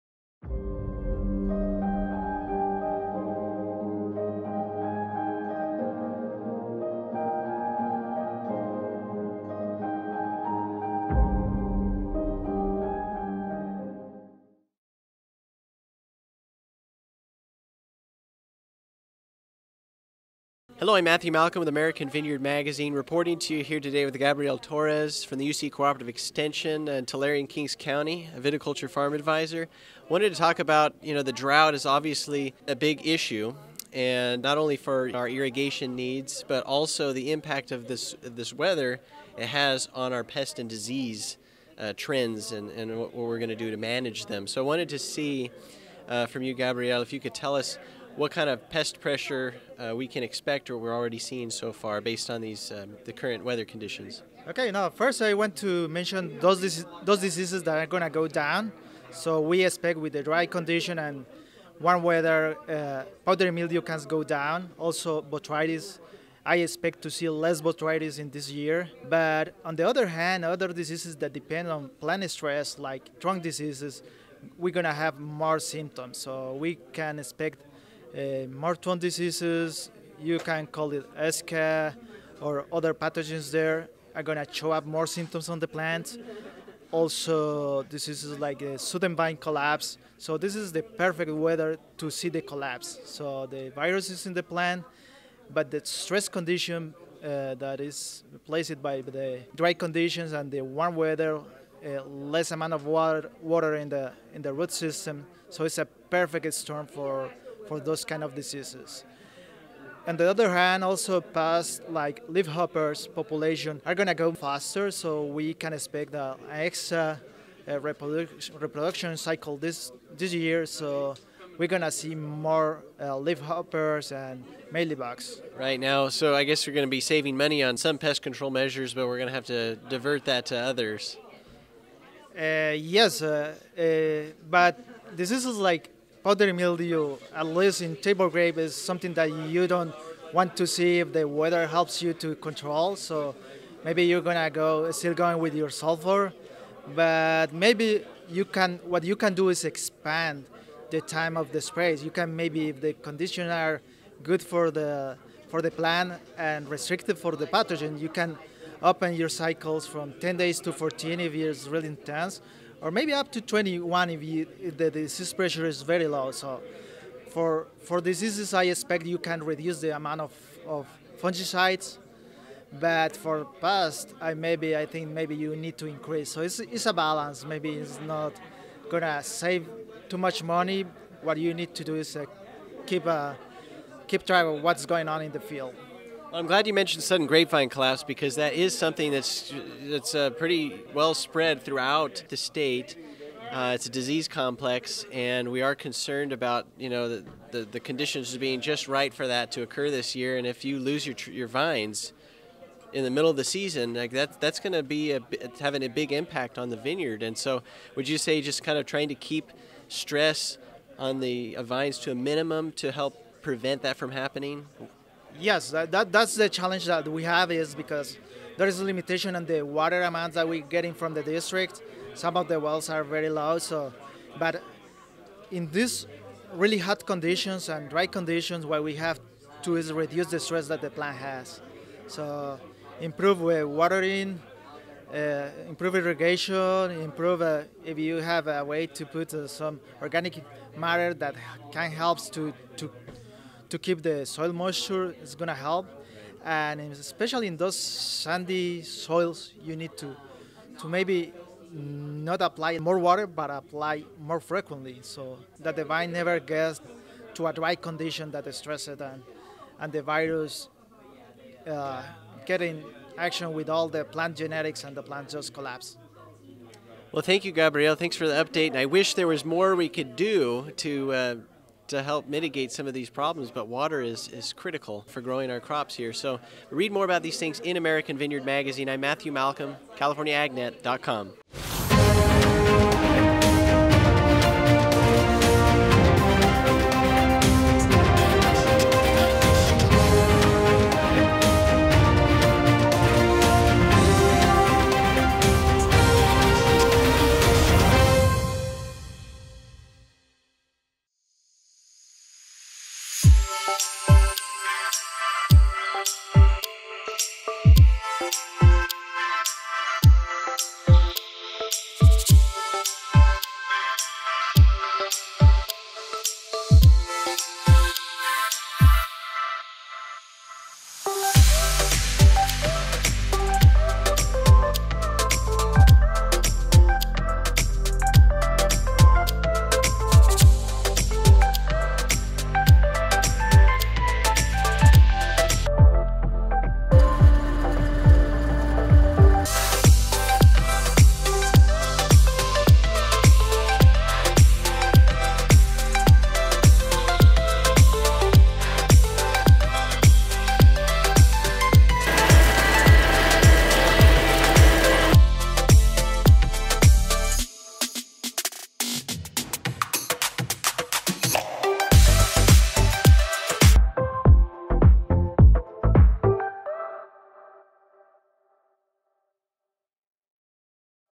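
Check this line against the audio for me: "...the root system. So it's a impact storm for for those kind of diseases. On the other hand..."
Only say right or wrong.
wrong.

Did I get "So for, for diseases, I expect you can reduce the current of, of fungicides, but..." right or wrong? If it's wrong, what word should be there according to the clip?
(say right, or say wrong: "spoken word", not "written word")
wrong: "amount", not "current".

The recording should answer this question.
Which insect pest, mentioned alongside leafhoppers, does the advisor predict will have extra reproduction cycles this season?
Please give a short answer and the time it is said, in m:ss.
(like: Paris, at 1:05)
Mealybugs, at 2:04.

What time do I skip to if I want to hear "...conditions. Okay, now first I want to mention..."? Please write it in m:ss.
0:53.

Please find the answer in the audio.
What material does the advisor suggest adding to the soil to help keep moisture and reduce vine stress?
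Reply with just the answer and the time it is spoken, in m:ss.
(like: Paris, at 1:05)
Organic matter, at 4:00.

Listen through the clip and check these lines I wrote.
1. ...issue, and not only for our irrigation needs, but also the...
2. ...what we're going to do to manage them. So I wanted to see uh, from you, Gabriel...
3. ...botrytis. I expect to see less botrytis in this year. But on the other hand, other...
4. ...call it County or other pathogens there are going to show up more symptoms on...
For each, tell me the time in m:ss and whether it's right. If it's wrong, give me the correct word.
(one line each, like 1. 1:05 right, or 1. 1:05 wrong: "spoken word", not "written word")
1. 0:33 right
2. 0:42 right
3. 1:05 right
4. 1:20 wrong: "ESCA", not "County".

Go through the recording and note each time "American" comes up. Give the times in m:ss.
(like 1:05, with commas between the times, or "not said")
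0:21, 4:37.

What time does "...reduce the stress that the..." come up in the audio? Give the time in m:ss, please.
3:49.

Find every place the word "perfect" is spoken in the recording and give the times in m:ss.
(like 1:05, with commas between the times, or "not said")
1:30, 1:45.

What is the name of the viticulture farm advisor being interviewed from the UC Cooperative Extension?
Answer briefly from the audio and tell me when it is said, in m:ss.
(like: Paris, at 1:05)
Gabriel Torres, at 0:24.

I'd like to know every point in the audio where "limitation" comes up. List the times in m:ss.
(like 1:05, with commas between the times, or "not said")
3:38.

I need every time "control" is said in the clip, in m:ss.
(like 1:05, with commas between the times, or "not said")
2:08, 2:22.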